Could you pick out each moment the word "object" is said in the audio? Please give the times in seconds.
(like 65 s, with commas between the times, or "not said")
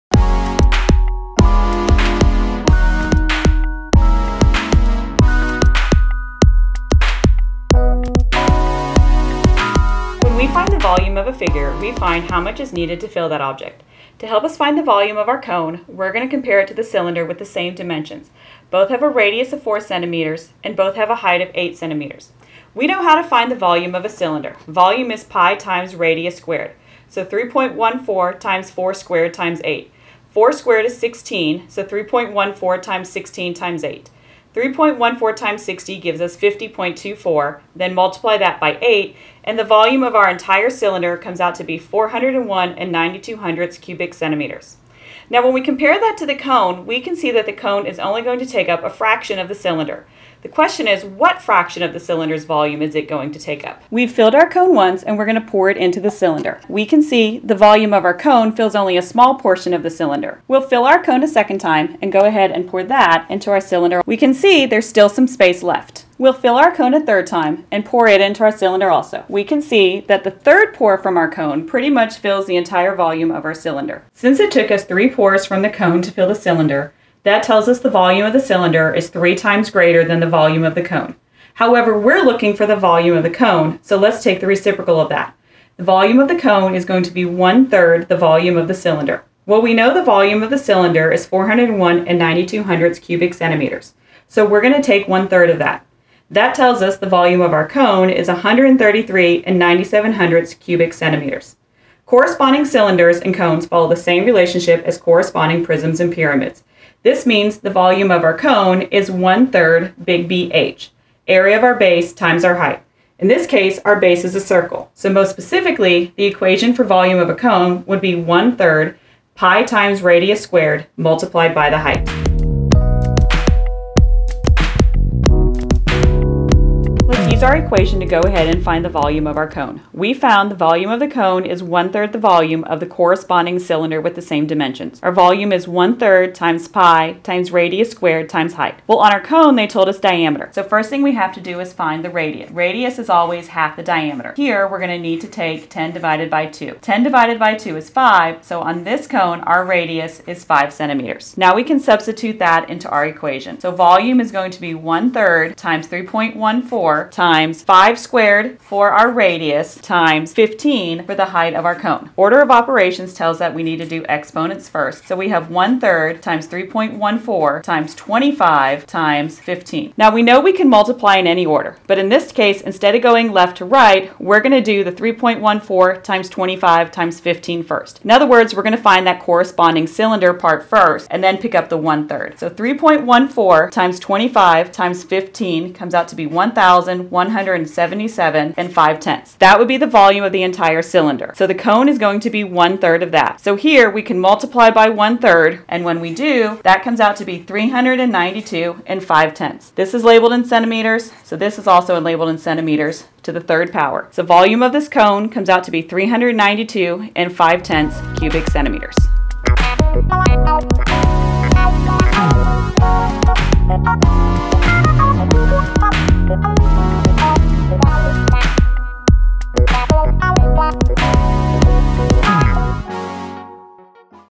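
13 s.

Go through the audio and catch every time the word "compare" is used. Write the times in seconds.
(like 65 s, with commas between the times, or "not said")
16 s, 45 s.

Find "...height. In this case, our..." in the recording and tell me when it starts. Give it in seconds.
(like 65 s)
112 s.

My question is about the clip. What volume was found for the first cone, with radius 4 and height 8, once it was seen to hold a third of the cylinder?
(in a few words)
133.97 cubic centimeters.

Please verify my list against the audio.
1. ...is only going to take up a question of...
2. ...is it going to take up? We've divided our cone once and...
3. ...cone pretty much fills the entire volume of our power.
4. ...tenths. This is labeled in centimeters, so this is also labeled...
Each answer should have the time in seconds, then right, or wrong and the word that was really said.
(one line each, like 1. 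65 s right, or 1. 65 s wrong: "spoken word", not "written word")
1. 47 s wrong: "fraction", not "question"
2. 52 s wrong: "filled", not "divided"
3. 71 s wrong: "cylinder", not "power"
4. 199 s right.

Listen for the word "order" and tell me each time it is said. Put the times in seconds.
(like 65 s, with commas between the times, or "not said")
162 s, 171 s.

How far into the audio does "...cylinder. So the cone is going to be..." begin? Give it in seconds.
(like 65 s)
190 s.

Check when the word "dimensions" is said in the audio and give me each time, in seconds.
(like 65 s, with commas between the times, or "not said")
17 s, 134 s.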